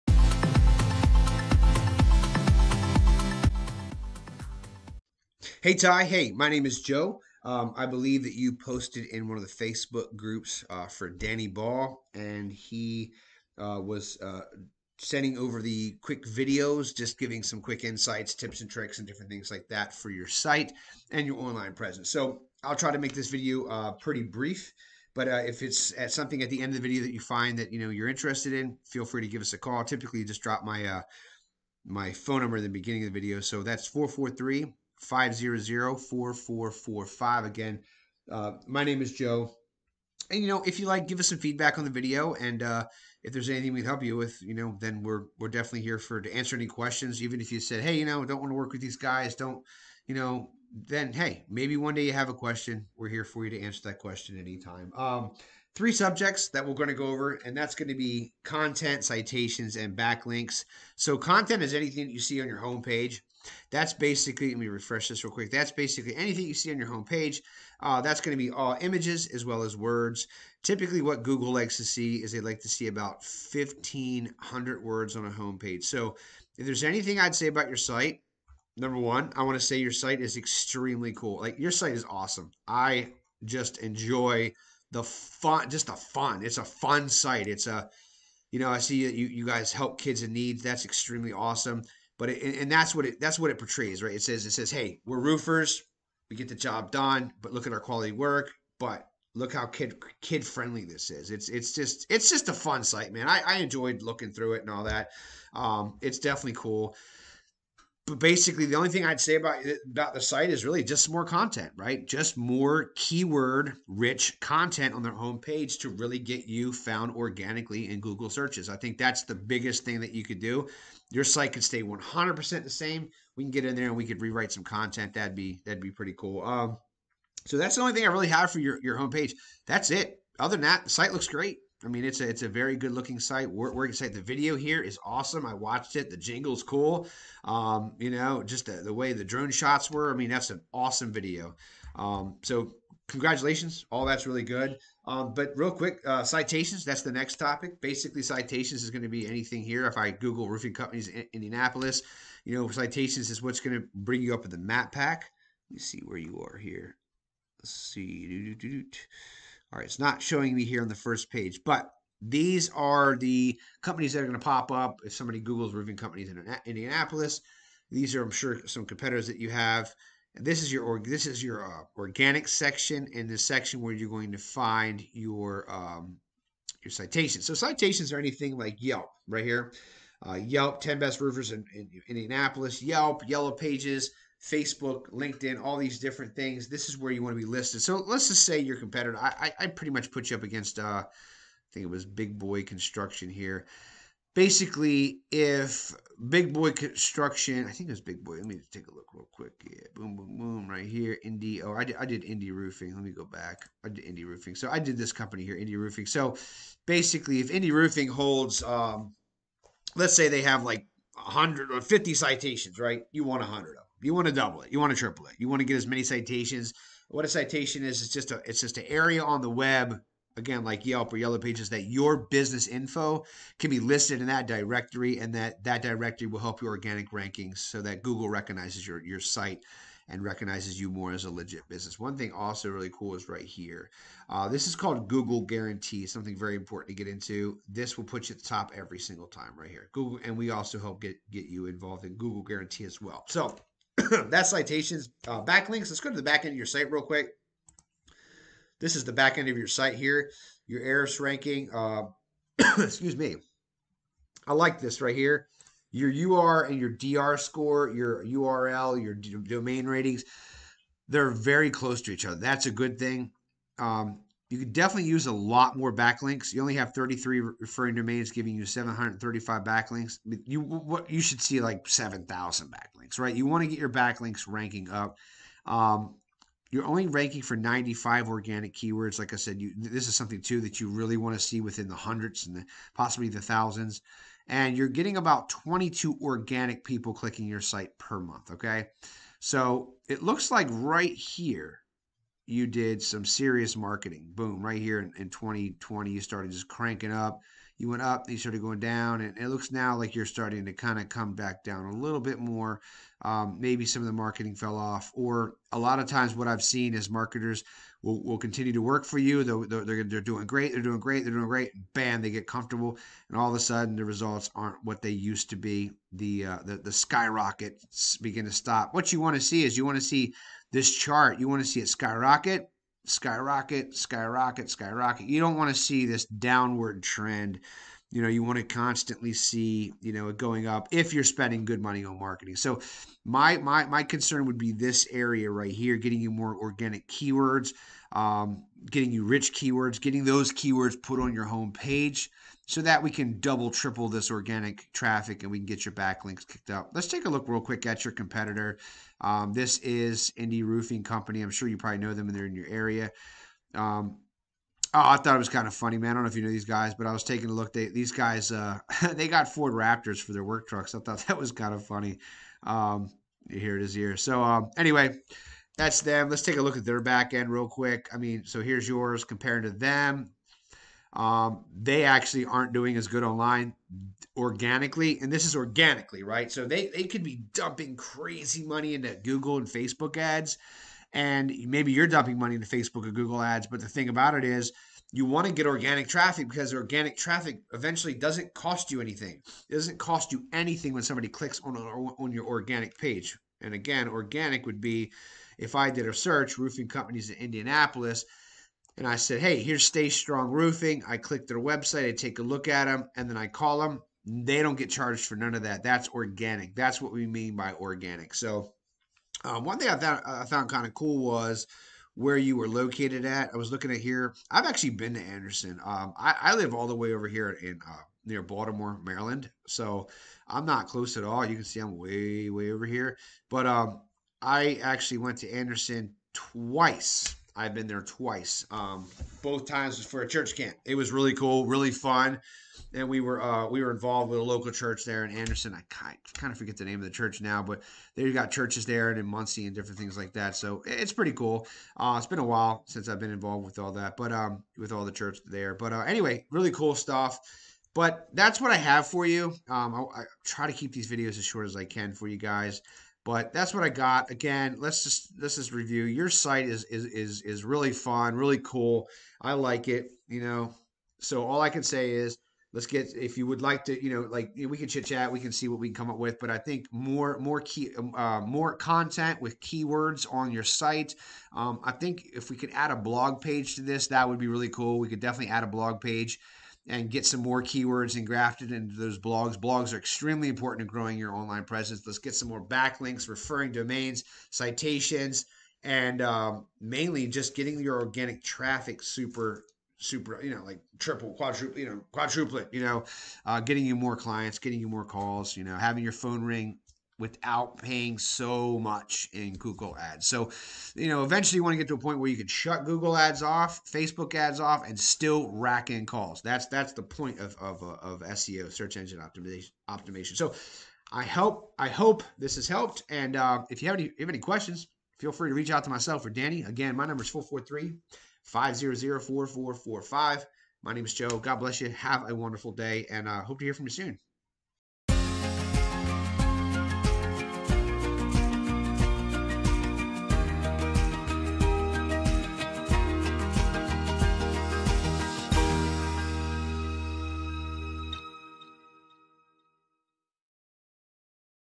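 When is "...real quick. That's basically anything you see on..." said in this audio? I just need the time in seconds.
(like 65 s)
65 s.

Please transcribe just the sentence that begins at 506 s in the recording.
That's that's the point of of, uh, of SEO, search engine optimization.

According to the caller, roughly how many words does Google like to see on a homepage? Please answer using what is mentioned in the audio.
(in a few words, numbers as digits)
1,500.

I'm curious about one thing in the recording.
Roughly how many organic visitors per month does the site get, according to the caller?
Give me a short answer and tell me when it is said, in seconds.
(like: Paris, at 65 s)
22, at 285 s.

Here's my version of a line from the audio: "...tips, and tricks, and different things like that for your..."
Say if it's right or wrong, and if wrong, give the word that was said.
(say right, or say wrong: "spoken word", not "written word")
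right.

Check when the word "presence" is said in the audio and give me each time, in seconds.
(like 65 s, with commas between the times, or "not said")
21 s, 481 s.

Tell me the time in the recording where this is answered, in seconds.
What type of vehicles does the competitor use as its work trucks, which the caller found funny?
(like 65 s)
359 s.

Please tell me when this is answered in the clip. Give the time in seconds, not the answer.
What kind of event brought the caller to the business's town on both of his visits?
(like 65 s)
430 s.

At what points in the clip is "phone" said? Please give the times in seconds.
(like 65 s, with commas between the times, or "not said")
32 s, 496 s.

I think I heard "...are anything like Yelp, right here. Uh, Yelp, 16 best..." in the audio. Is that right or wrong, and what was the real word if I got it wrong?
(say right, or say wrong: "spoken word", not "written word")
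wrong: "10", not "16".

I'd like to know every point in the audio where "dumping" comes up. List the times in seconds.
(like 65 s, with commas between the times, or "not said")
377 s, 382 s.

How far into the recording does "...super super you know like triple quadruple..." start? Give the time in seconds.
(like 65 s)
489 s.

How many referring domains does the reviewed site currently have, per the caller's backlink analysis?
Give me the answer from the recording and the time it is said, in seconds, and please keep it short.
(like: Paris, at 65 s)
33, at 266 s.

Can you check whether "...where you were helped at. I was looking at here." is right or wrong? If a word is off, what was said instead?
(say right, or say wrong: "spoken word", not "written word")
wrong: "located", not "helped".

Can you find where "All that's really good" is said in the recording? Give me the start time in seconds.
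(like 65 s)
143 s.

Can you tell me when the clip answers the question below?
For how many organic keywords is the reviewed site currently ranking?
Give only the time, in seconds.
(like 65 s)
277 s.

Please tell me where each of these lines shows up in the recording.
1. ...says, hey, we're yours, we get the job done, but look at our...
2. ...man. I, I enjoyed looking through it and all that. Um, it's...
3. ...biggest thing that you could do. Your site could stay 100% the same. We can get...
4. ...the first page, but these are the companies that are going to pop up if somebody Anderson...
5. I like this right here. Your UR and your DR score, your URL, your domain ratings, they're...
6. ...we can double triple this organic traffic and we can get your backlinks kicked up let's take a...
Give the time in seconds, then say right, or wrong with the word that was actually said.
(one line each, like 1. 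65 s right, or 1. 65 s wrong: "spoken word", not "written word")
1. 94 s wrong: "roofers", not "yours"
2. 103 s right
3. 119 s right
4. 160 s wrong: "Googles", not "Anderson"
5. 254 s right
6. 343 s right.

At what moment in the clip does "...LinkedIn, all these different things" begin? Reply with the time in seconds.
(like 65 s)
185 s.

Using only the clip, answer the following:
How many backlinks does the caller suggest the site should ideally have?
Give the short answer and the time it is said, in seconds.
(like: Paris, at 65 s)
7,000, at 271 s.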